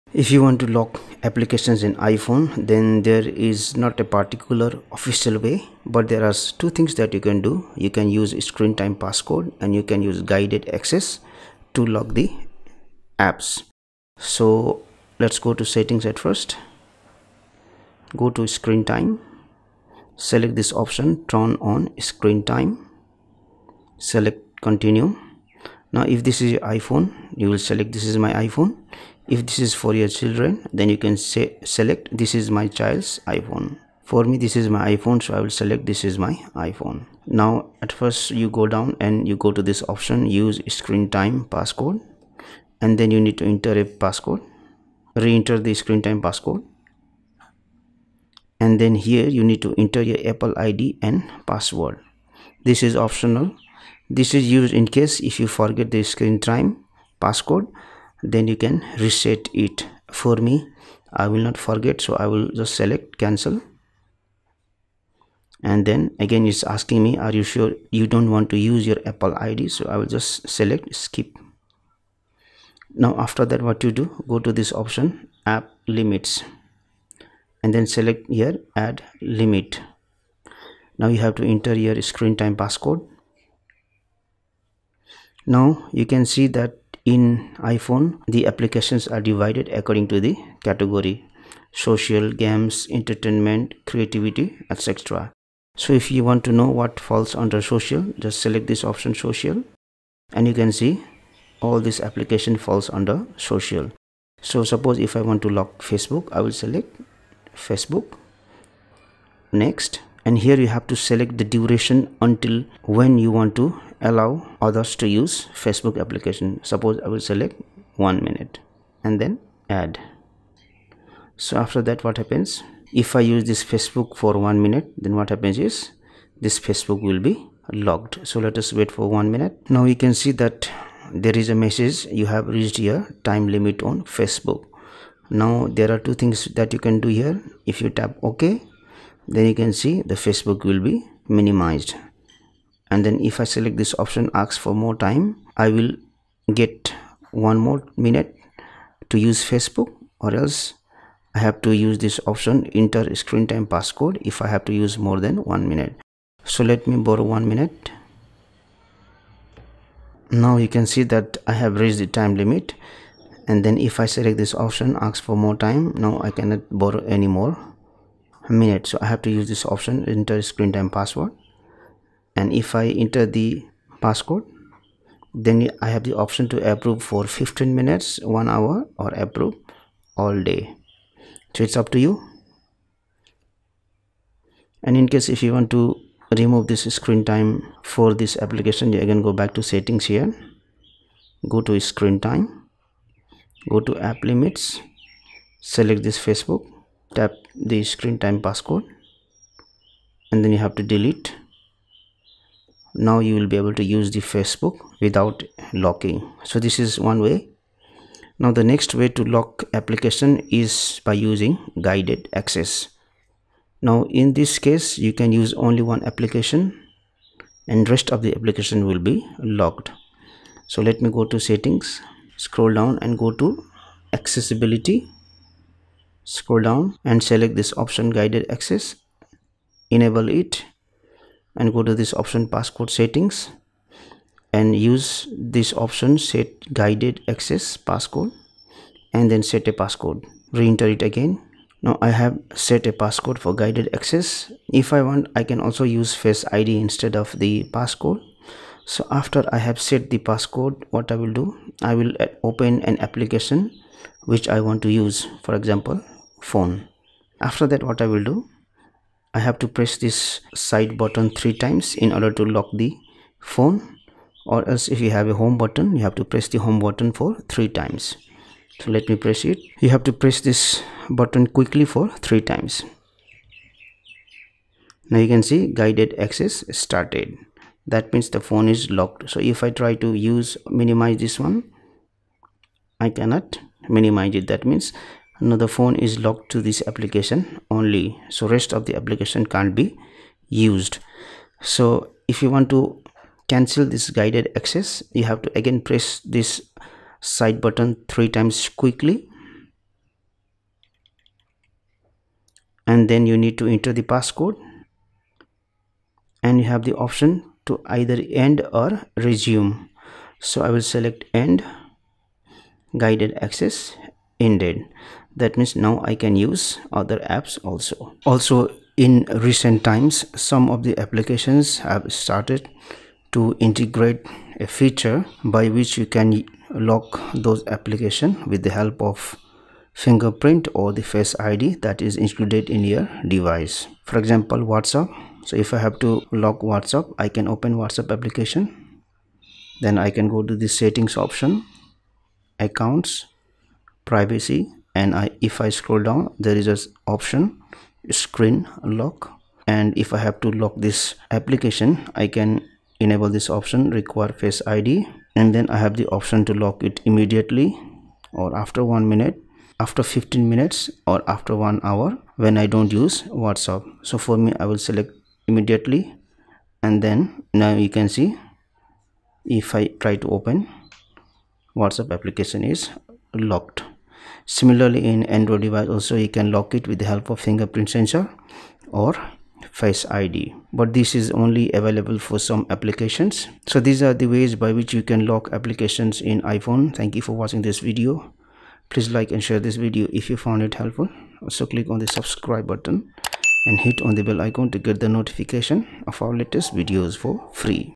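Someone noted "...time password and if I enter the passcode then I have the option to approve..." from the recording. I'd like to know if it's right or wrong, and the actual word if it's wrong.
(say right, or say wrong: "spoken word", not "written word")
right.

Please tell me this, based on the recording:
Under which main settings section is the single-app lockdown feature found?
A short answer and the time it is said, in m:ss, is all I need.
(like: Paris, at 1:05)
Accessibility, at 3:44.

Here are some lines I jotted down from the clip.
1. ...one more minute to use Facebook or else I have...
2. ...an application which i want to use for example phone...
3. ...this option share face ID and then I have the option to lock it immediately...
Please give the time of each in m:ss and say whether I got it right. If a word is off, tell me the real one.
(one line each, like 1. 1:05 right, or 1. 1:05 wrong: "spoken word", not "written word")
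1. 2:27 right
2. 4:12 right
3. 5:53 wrong: "require", not "share".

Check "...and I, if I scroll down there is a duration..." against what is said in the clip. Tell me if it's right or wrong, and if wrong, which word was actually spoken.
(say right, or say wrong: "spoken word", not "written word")
wrong: "option", not "duration".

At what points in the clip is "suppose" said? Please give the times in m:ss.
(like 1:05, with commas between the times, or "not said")
1:44, 1:56.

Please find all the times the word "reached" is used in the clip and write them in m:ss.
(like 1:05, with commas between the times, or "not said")
2:12, 2:41.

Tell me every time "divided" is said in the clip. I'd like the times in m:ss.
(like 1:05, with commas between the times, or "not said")
1:29.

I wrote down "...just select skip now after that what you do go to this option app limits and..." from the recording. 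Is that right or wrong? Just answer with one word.
right.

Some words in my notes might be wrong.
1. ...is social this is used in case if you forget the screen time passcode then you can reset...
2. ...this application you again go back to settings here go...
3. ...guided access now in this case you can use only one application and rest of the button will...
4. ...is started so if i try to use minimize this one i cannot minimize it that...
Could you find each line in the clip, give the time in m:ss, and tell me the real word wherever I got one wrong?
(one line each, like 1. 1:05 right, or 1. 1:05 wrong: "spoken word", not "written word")
1. 0:52 wrong: "optional", not "social"
2. 3:08 right
3. 3:31 wrong: "application", not "button"
4. 4:38 wrong: "locked", not "started".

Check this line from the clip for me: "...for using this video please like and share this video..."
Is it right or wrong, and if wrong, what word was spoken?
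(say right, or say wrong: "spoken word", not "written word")
wrong: "watching", not "using".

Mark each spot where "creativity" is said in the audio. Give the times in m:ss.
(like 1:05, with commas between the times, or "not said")
1:33.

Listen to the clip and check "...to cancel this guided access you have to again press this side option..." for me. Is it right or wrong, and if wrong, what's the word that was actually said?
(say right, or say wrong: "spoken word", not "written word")
wrong: "button", not "option".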